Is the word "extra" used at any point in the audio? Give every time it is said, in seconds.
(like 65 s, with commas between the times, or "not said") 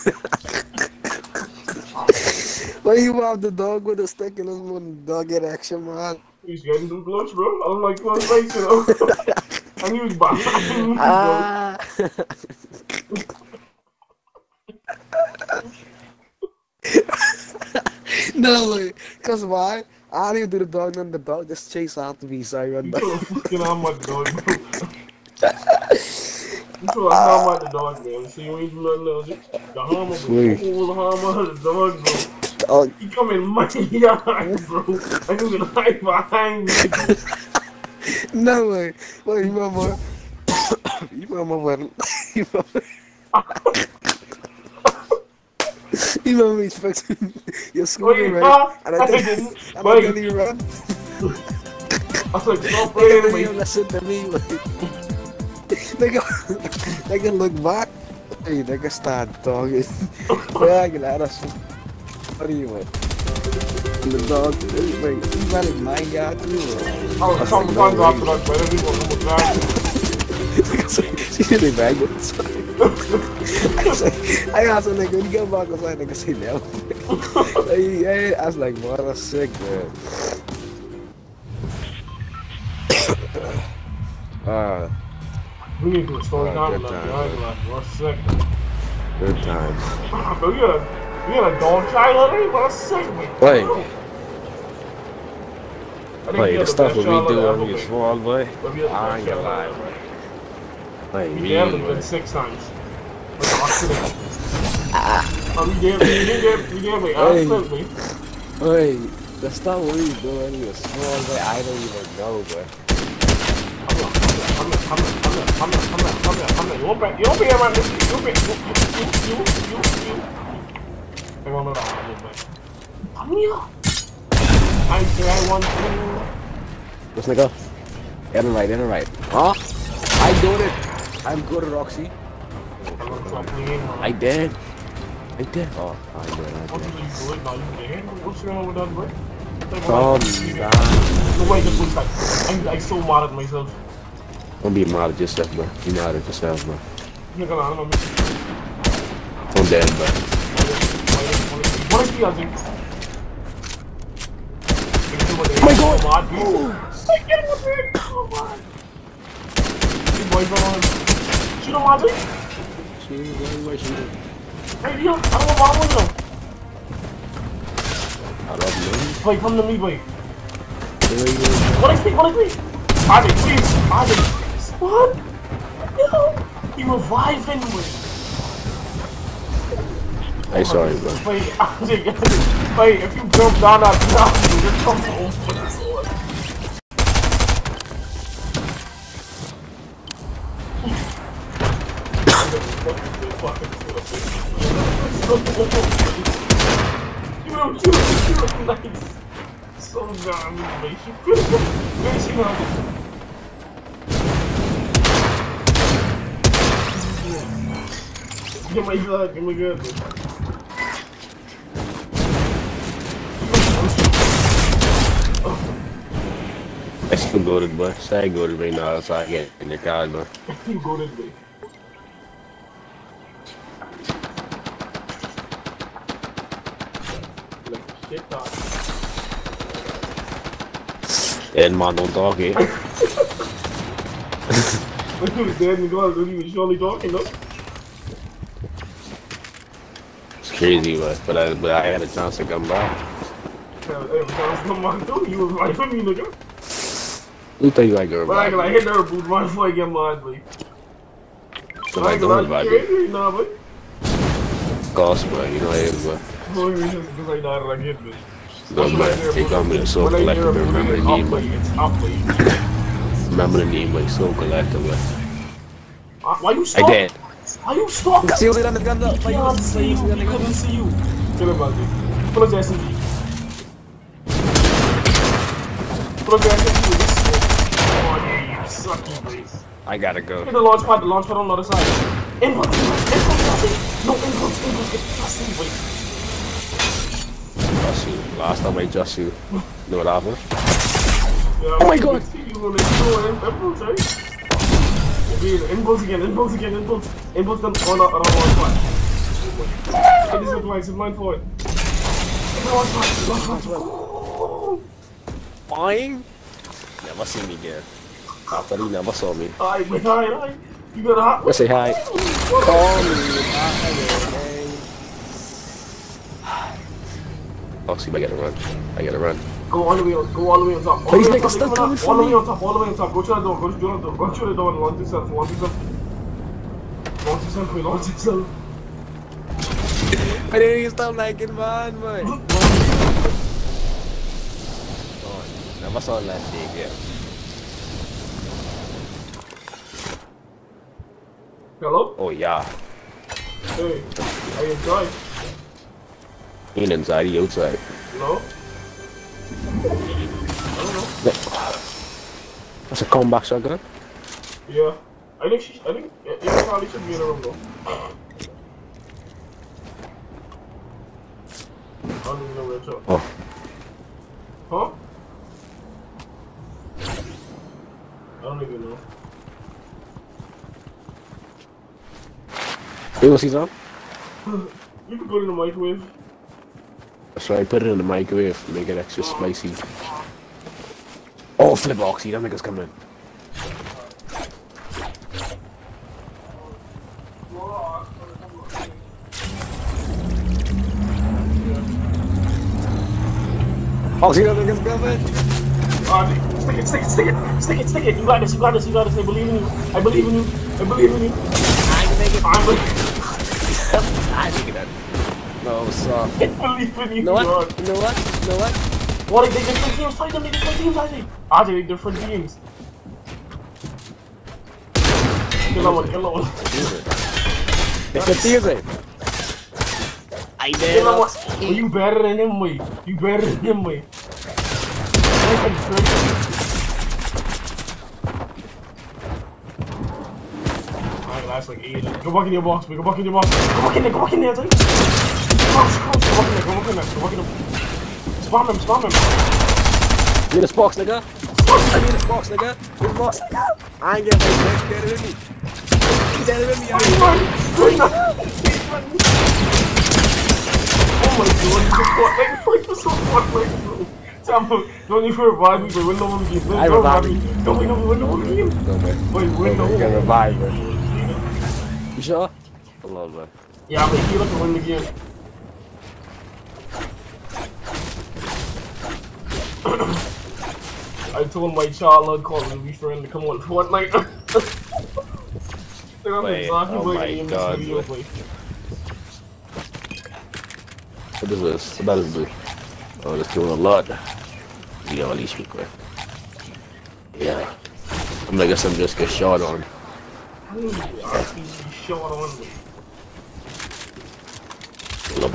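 5 s, 378 s.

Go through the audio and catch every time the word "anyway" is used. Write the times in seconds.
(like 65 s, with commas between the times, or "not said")
110 s, 177 s.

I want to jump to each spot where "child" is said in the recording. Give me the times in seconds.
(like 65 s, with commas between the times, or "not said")
91 s, 471 s.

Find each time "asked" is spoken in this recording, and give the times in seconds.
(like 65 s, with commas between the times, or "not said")
74 s.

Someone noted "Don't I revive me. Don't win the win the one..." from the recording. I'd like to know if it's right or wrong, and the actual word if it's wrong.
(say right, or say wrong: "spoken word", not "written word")
right.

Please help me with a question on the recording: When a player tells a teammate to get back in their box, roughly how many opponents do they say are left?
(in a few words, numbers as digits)
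8.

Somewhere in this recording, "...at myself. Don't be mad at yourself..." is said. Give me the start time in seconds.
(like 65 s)
143 s.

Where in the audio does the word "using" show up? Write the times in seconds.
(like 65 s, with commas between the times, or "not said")
152 s.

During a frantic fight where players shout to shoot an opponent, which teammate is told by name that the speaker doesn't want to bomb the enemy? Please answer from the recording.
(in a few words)
Leo.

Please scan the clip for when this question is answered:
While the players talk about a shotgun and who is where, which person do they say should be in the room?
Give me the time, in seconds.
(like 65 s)
356 s.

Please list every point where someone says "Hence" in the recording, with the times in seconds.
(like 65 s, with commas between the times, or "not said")
not said.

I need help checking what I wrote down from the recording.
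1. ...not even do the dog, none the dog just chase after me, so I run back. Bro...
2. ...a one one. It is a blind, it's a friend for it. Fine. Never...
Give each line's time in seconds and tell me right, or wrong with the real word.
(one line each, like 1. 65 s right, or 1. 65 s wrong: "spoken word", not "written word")
1. 20 s right
2. 298 s wrong: "blind", not "friend".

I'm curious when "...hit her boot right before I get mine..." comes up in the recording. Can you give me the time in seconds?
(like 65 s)
248 s.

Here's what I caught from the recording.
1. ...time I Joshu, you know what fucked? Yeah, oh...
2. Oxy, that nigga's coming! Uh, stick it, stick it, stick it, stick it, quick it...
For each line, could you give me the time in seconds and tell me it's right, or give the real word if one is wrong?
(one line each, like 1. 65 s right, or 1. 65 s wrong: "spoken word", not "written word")
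1. 288 s wrong: "happened", not "fucked"
2. 394 s wrong: "stick", not "quick".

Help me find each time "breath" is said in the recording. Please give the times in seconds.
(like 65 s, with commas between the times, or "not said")
not said.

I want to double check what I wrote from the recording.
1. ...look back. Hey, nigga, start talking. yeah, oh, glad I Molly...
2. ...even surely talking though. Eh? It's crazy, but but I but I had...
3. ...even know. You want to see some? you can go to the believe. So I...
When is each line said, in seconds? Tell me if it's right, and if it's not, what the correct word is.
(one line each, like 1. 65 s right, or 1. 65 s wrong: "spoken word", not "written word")
1. 57 s wrong: "What", not "Molly"
2. 236 s right
3. 368 s wrong: "microwave", not "believe".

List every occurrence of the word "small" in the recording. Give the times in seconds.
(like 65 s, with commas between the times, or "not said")
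97 s, 110 s.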